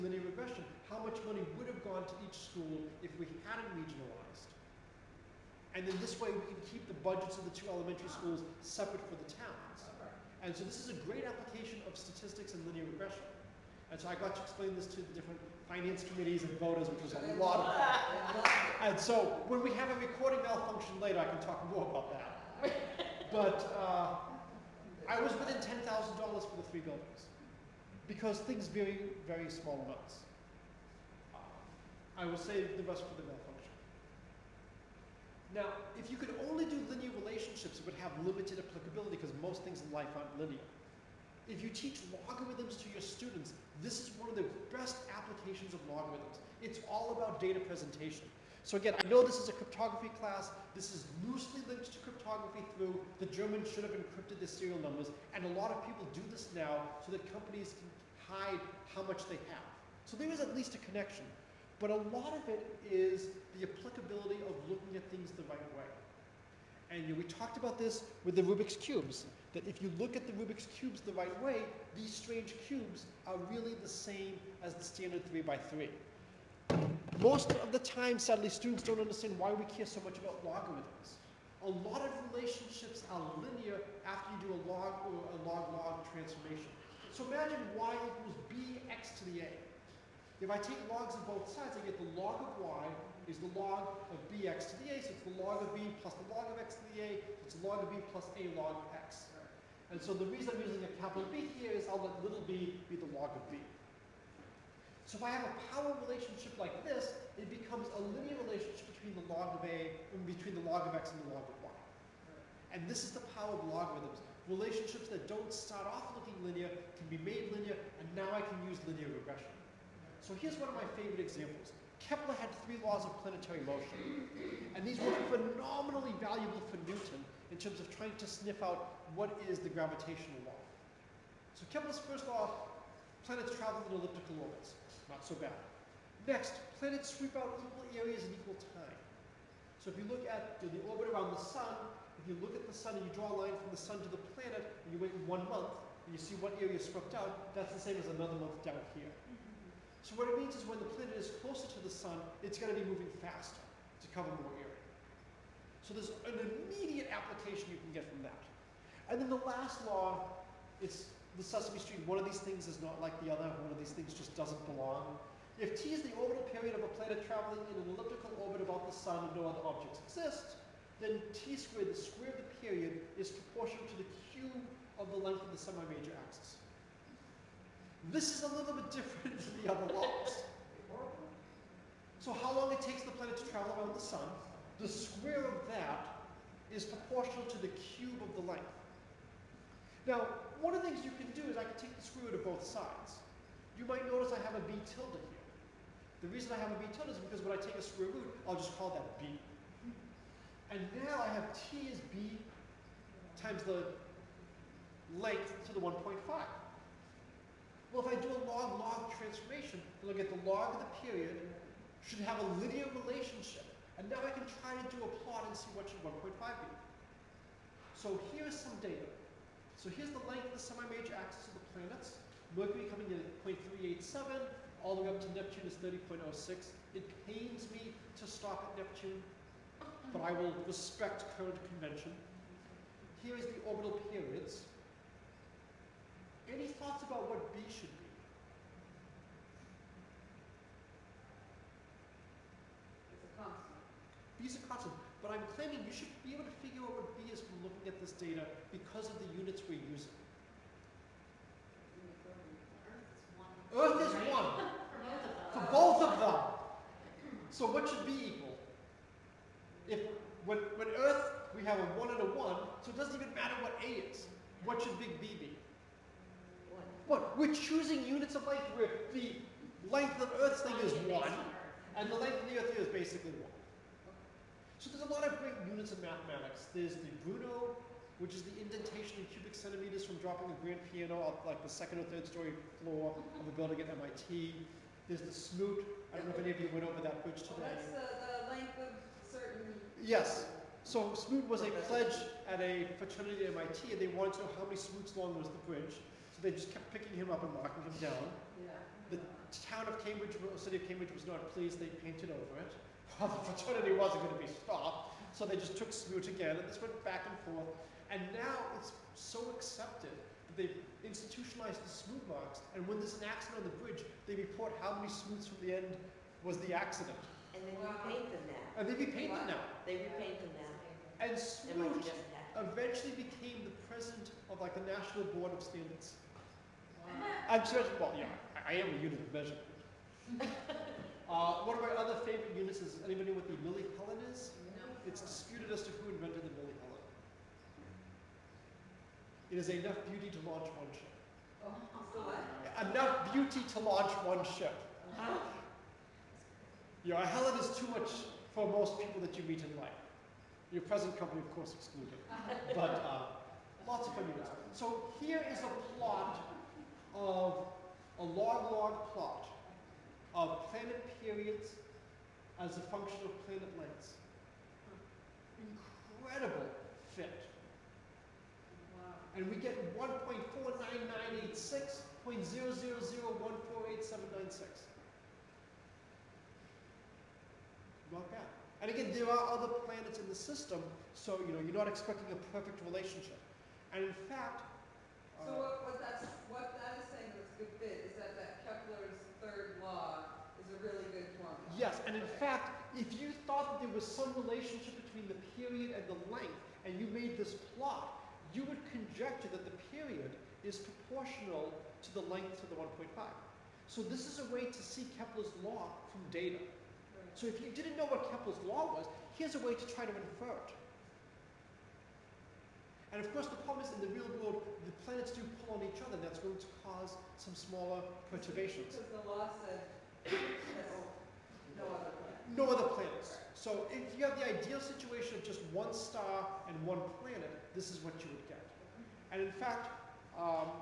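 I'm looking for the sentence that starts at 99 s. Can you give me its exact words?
And so the reason I'm using a capital B here is I'll let little b be the log of b.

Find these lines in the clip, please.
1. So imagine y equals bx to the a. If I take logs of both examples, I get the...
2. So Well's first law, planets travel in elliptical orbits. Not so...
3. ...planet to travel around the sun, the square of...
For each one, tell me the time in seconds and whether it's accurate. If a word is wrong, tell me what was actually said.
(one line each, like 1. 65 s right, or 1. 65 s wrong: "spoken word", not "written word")
1. 87 s wrong: "sides", not "examples"
2. 131 s wrong: "Kepler", not "Well"
3. 183 s right.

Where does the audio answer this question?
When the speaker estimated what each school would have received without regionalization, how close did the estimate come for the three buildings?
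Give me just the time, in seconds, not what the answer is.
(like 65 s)
25 s.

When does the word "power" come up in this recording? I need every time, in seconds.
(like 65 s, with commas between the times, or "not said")
105 s, 113 s.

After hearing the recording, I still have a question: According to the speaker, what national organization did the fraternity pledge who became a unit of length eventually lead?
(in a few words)
National Board of Standards.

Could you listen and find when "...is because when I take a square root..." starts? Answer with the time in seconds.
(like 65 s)
197 s.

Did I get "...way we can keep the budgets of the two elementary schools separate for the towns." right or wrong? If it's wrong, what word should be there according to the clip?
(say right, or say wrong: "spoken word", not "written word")
right.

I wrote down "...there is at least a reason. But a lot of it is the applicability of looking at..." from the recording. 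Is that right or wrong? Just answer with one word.
wrong.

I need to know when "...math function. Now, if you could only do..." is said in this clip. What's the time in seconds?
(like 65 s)
33 s.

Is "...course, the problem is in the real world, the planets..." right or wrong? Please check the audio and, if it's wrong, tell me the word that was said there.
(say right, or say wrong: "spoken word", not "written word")
right.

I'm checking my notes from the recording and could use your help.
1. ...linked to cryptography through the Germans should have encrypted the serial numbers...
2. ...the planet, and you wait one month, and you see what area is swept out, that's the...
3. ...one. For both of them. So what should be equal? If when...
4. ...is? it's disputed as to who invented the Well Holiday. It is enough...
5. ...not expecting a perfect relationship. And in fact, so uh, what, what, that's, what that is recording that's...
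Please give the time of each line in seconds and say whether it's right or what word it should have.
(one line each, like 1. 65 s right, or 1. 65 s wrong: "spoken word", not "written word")
1. 51 s right
2. 144 s right
3. 254 s right
4. 334 s wrong: "Billy", not "Well"
5. 381 s wrong: "saying", not "recording".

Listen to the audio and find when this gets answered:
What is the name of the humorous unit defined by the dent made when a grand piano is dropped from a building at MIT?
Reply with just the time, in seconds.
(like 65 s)
277 s.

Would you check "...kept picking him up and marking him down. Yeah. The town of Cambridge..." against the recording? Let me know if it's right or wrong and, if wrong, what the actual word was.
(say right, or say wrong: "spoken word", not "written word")
right.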